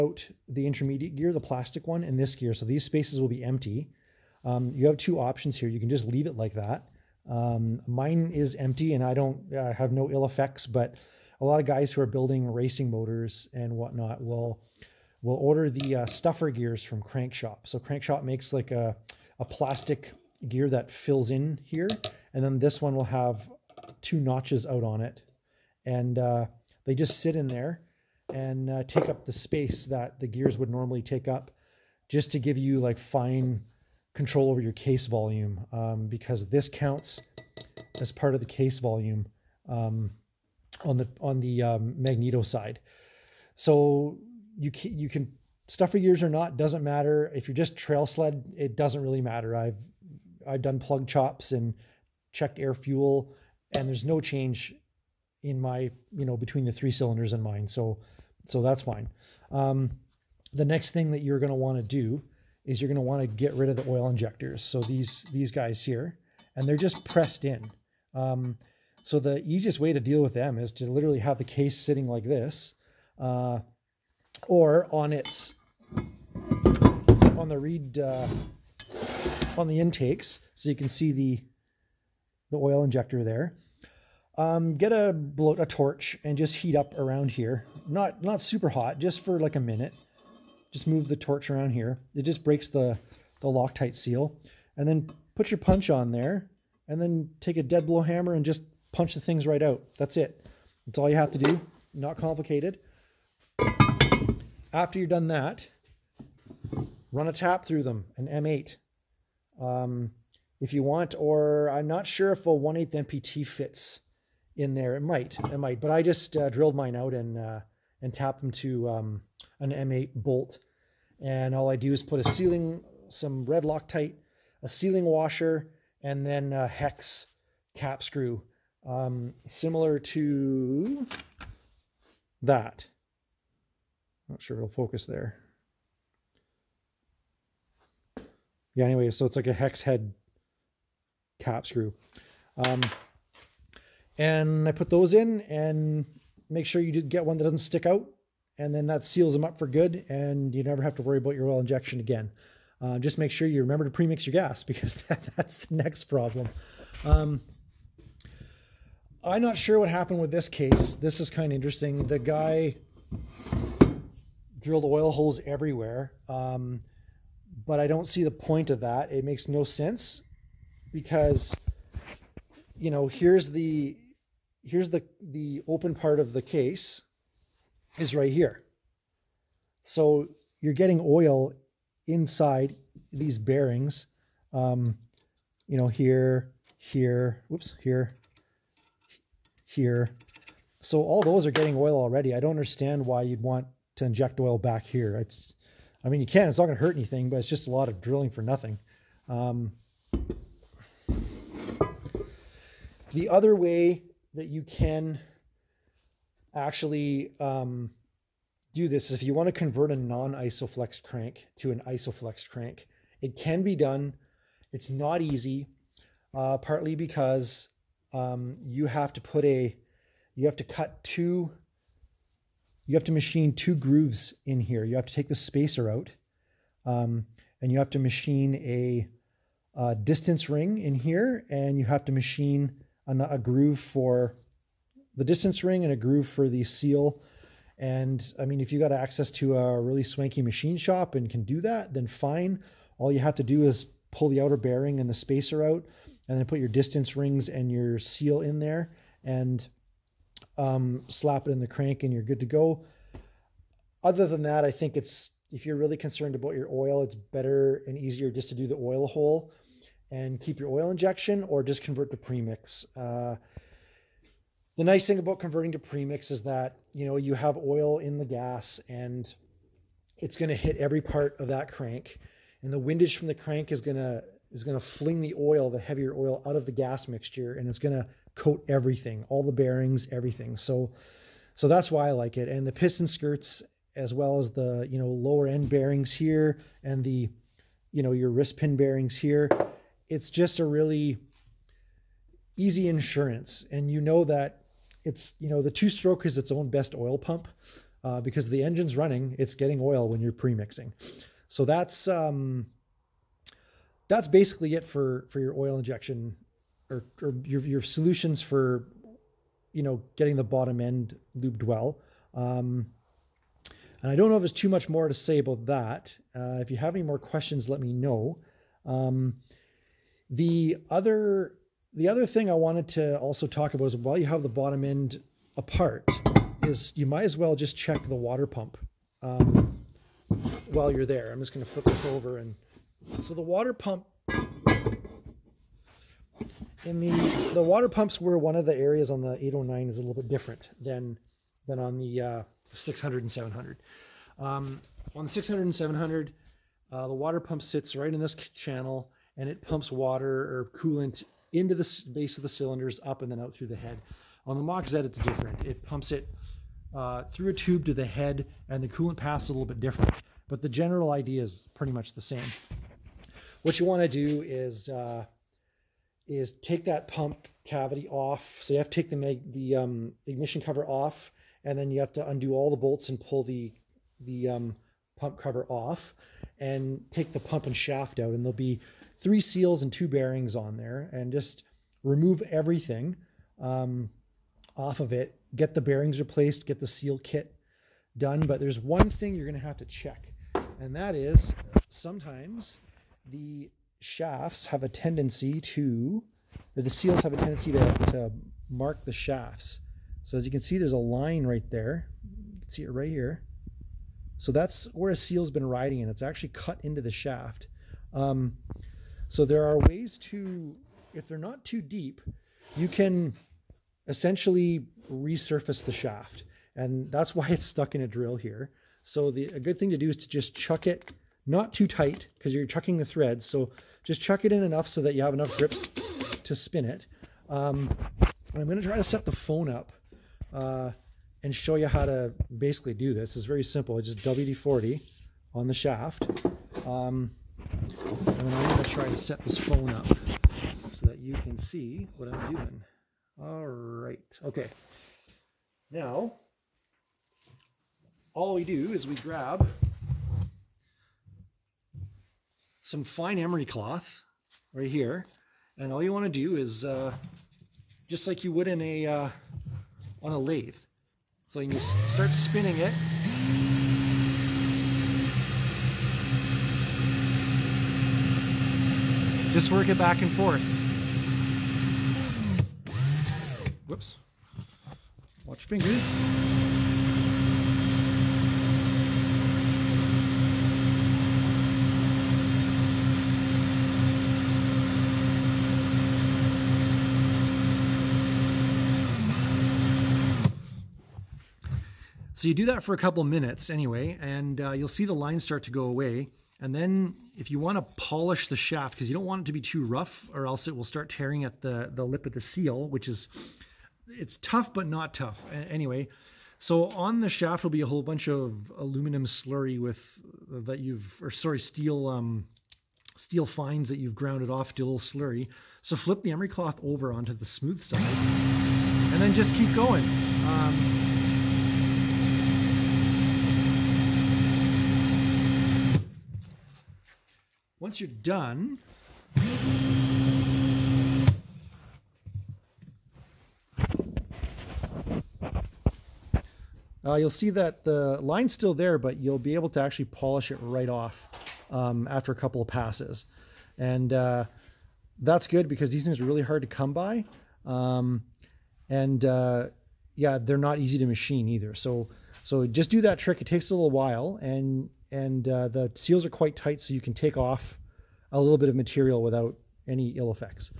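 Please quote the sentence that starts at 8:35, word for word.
So flip the emery cloth over onto the smooth side and then just keep going.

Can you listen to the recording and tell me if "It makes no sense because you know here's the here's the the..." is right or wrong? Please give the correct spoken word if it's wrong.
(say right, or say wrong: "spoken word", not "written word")
right.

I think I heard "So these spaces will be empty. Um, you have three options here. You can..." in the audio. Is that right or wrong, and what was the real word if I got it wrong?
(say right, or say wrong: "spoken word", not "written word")
wrong: "two", not "three".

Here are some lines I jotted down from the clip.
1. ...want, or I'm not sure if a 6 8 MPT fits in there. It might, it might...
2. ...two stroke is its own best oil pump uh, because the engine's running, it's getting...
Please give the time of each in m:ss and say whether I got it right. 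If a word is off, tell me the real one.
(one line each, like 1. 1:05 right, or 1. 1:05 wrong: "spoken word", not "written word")
1. 1:50 wrong: "1", not "6"
2. 4:55 right.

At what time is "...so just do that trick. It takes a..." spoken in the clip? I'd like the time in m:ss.
9:12.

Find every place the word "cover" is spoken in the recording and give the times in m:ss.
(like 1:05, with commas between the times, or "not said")
6:10, 6:15.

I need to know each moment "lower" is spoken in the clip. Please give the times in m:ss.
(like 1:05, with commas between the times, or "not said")
4:45.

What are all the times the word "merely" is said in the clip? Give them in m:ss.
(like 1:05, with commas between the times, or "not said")
not said.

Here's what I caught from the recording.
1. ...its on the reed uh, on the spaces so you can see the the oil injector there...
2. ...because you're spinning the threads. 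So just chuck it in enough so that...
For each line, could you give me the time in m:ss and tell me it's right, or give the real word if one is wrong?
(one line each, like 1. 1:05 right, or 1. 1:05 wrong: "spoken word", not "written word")
1. 1:15 wrong: "intakes", not "spaces"
2. 7:02 wrong: "chucking", not "spinning".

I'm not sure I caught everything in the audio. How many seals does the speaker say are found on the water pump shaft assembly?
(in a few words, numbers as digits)
3.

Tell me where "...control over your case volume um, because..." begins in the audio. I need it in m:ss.
0:34.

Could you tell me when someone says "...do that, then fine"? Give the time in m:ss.
4:01.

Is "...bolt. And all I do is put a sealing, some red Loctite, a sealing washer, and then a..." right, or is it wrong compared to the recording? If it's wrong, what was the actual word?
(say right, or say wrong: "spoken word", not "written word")
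right.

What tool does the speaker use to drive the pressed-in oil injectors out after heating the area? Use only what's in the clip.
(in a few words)
dead blow hammer.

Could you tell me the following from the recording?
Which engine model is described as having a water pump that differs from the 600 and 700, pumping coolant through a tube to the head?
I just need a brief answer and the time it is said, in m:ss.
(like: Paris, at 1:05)
809, at 5:39.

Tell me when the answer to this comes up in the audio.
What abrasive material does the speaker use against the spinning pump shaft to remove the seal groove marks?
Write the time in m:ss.
7:33.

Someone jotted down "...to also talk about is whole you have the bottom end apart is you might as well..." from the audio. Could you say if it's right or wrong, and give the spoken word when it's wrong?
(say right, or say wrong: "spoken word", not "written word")
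wrong: "while", not "whole".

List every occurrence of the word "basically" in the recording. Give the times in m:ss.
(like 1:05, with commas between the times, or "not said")
5:04, 7:12.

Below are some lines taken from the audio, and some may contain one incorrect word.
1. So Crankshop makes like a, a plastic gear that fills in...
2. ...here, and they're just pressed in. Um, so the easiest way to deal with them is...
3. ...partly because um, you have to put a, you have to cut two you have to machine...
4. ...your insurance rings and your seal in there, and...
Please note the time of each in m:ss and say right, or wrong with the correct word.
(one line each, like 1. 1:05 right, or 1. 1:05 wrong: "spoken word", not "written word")
1. 0:17 right
2. 1:05 right
3. 3:36 right
4. 4:06 wrong: "distance", not "insurance".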